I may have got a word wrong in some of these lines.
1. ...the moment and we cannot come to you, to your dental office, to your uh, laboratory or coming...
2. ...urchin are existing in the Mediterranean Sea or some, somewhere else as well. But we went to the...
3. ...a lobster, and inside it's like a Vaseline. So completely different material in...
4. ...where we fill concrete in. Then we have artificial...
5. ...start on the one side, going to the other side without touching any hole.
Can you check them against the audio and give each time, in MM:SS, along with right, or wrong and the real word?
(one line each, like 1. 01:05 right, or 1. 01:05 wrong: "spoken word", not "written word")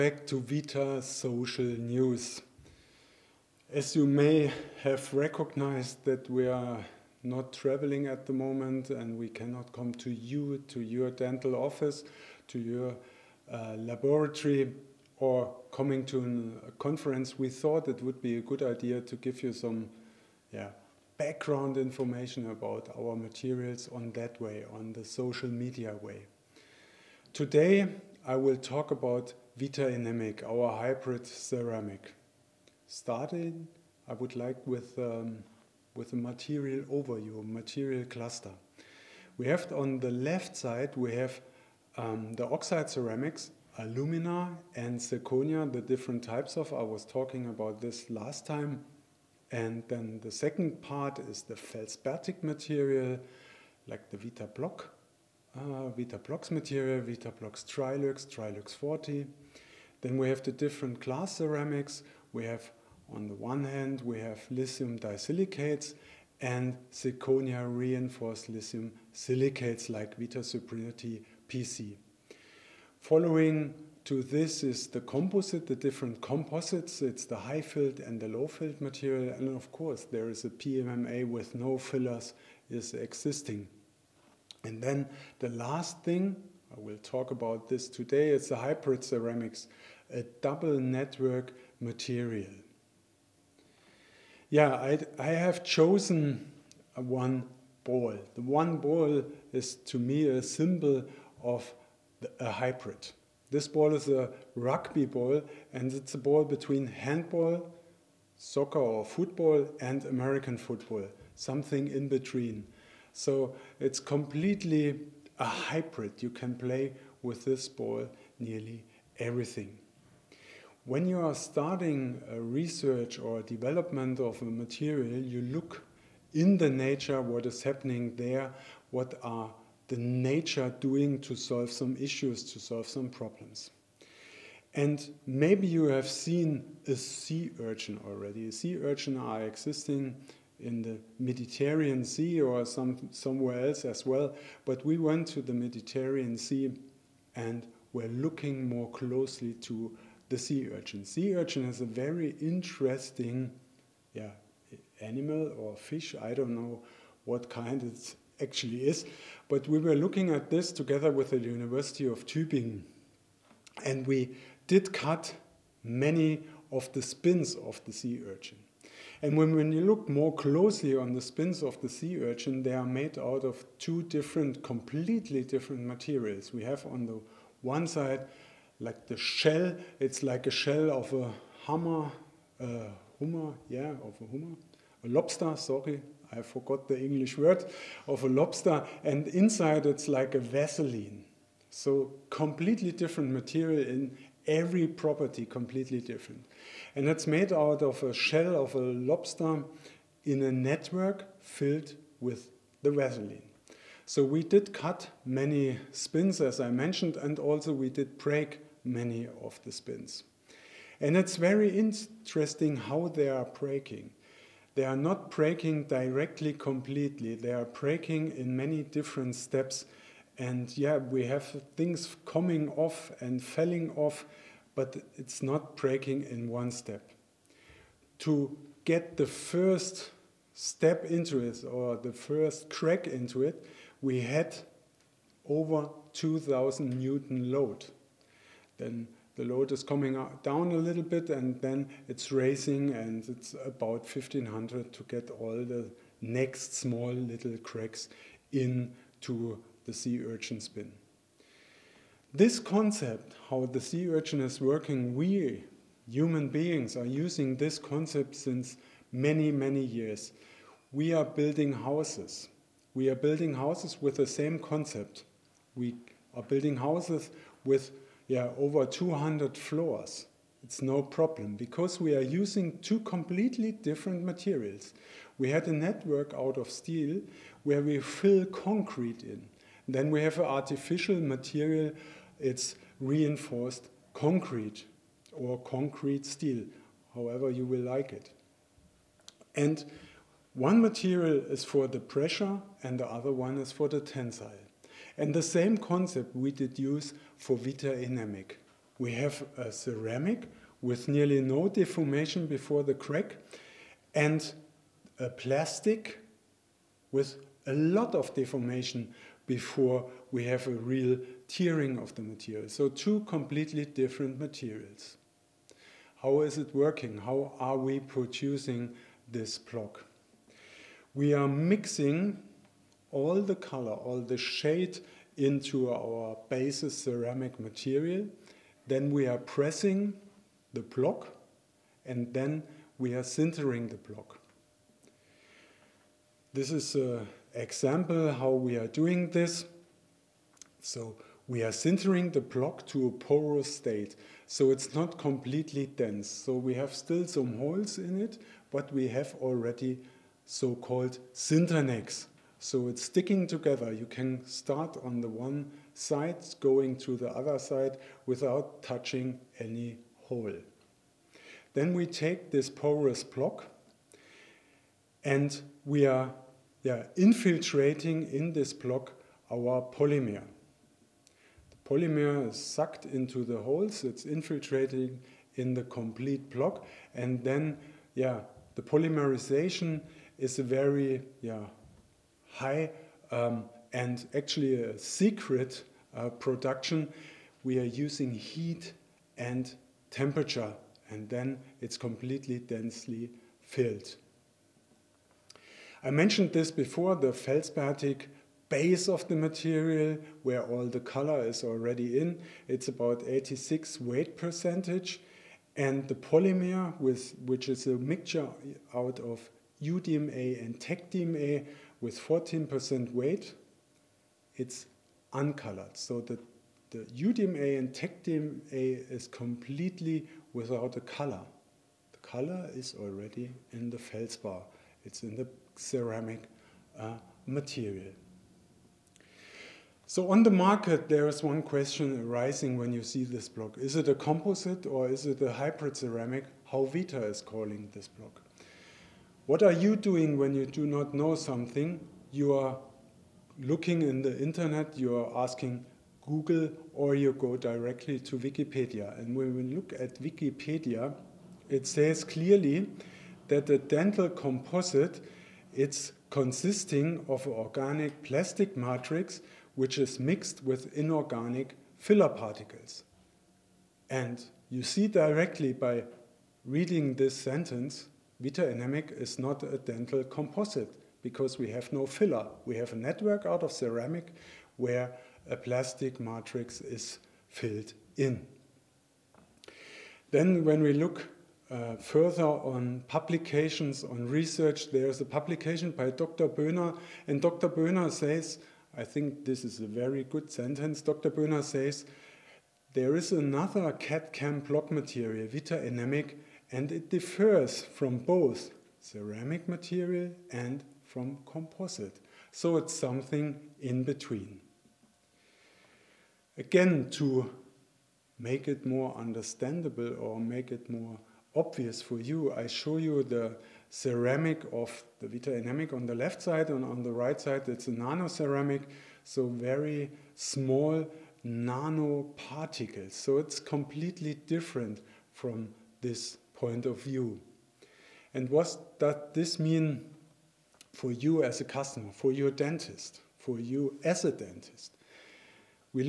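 1. 00:08 right
2. 02:18 right
3. 03:08 right
4. 04:37 right
5. 05:54 right.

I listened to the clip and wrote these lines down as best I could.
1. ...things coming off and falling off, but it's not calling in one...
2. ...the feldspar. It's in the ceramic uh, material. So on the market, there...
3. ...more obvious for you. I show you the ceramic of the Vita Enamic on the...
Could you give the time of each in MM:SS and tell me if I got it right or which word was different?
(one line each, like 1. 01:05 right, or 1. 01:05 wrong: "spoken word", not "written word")
1. 03:41 wrong: "breaking", not "calling"
2. 07:03 right
3. 08:30 right.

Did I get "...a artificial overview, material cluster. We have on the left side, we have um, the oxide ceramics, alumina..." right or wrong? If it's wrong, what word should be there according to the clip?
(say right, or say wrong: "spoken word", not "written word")
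wrong: "material", not "artificial".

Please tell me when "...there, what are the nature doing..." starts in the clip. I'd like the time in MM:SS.
02:08.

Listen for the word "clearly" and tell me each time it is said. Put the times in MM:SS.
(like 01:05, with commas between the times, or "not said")
07:32.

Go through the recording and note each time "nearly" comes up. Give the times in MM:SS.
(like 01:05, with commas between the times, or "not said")
01:58, 05:01.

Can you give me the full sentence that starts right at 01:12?
Following to this is the composite, the different composites.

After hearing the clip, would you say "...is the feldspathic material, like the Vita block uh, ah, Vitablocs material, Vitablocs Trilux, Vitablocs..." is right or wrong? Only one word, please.
wrong.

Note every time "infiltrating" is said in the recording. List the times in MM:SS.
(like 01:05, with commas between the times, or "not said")
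06:07, 06:14.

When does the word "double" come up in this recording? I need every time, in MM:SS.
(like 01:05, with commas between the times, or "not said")
01:30.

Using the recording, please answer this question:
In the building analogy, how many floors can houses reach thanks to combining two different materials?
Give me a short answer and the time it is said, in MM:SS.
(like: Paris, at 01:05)
Over 200, at 04:28.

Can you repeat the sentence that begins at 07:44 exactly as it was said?
And you see directly by reading this sentence, Vita Enamic is not a dental composite because we have no filler.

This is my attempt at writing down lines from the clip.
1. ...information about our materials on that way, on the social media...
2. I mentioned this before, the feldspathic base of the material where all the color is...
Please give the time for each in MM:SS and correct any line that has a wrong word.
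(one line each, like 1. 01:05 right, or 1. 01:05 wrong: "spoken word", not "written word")
1. 00:21 right
2. 06:36 right.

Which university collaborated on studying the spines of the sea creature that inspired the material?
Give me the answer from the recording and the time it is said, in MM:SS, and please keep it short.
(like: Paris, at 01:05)
University of Tübingen, at 02:41.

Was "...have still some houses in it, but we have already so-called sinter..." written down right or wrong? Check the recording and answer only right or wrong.
wrong.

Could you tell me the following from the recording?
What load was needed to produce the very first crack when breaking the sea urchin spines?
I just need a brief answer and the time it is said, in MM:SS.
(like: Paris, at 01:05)
Over 2000 Newton, at 03:55.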